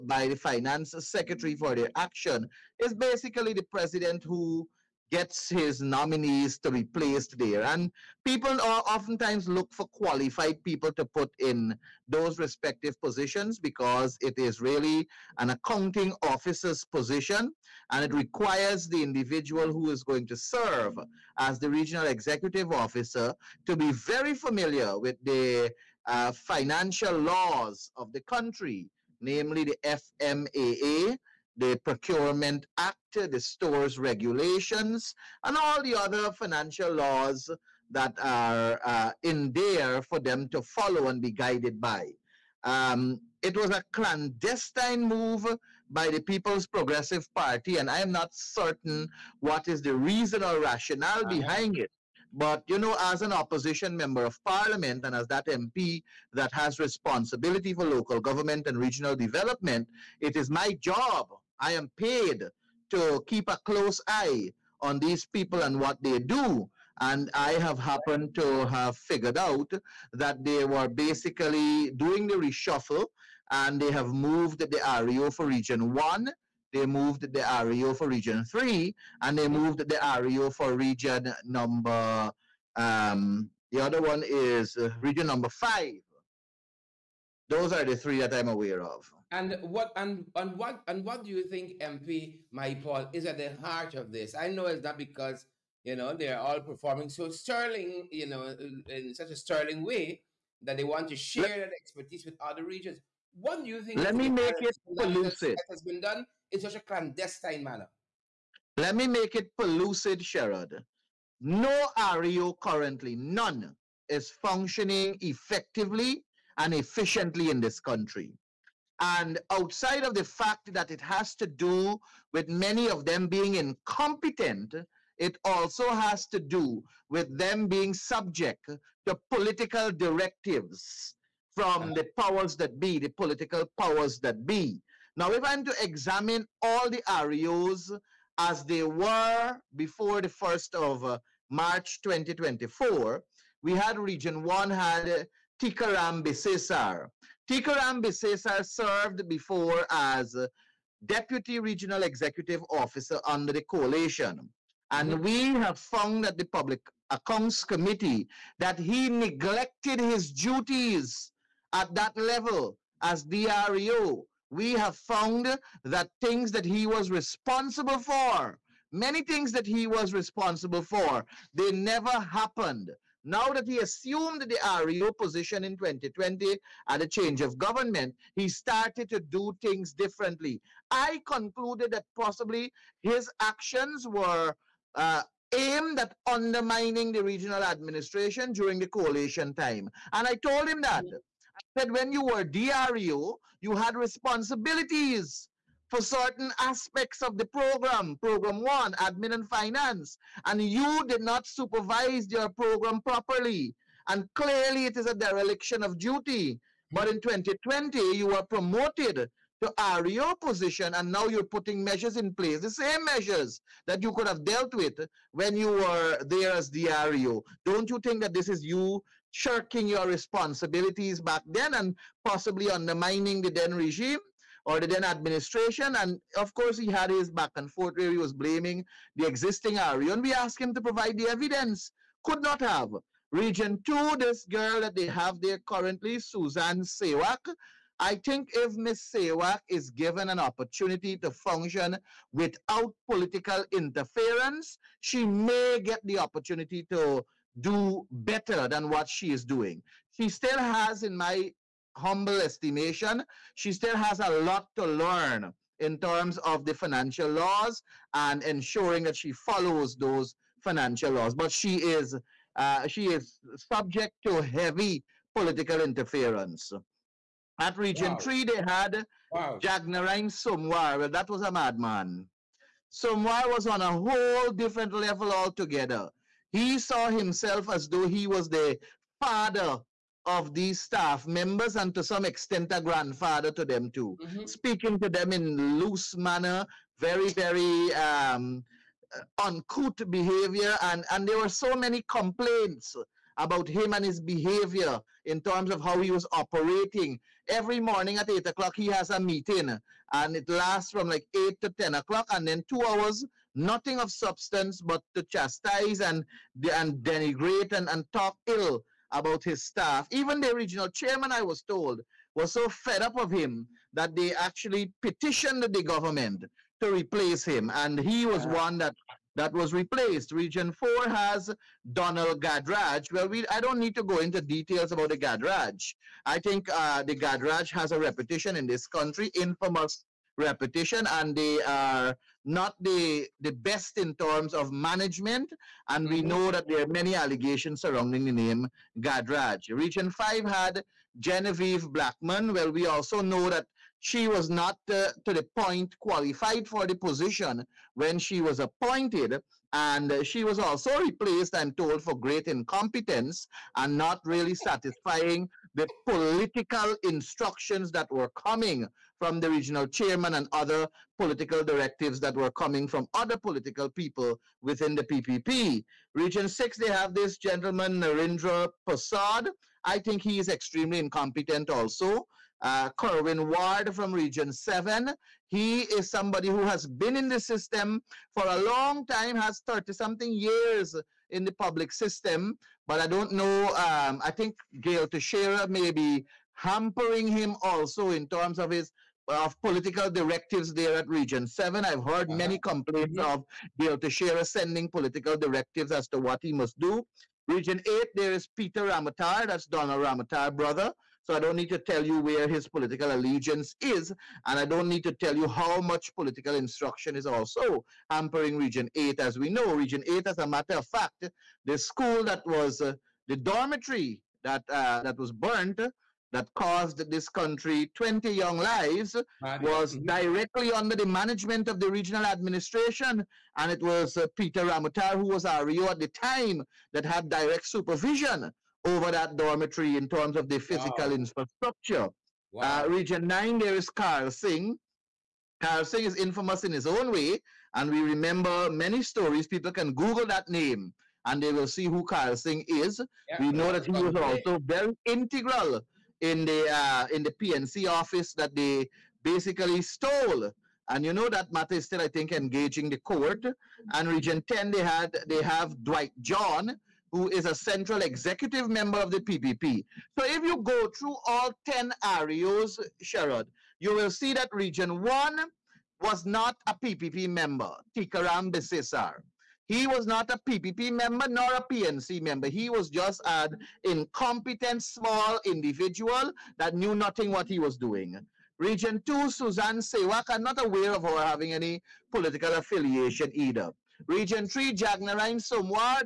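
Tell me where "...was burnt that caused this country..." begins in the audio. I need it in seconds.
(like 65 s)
415 s.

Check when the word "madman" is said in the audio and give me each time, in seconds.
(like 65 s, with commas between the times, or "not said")
271 s.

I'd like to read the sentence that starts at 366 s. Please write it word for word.
Region 6, they have this gentleman, Narendra Prasad.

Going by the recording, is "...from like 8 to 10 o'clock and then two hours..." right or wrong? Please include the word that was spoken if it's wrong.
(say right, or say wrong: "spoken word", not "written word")
right.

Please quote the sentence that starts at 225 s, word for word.
And of course, he had his back and forth where he was blaming the existing RU.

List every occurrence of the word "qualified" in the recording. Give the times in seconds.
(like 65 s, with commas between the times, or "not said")
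9 s, 345 s.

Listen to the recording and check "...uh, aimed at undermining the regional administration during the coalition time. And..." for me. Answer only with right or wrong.
right.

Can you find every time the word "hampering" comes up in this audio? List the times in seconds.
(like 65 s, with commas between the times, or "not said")
386 s, 408 s.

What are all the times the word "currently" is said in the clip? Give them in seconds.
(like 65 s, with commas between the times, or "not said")
112 s, 235 s.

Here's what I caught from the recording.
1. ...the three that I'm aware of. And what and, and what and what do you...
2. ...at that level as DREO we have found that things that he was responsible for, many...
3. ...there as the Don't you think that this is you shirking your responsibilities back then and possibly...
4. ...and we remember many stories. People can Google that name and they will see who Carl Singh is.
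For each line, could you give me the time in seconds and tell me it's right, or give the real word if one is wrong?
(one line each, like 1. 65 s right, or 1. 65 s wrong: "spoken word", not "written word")
1. 87 s right
2. 161 s right
3. 216 s right
4. 437 s right.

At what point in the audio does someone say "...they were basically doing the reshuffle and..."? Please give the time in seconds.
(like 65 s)
70 s.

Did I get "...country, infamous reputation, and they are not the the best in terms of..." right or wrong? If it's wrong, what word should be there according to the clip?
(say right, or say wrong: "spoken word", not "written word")
right.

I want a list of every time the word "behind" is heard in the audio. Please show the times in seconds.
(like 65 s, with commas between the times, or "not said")
51 s.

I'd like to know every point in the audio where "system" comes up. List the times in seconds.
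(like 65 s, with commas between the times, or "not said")
377 s, 381 s.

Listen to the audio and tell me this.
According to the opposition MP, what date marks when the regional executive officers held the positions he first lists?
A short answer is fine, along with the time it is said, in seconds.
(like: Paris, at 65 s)
1st of March 2024, at 140 s.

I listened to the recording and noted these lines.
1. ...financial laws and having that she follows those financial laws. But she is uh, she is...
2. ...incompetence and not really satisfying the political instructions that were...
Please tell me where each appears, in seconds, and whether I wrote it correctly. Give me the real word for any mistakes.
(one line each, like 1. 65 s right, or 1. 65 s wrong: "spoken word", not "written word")
1. 256 s wrong: "ensuring", not "having"
2. 352 s right.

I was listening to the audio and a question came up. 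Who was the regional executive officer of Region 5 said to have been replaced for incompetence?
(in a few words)
Genevieve Blackman.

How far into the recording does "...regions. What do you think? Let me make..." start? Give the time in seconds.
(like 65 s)
102 s.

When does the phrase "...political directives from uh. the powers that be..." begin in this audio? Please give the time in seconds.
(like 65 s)
129 s.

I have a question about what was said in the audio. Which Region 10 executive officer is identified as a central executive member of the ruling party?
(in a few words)
Dwight John.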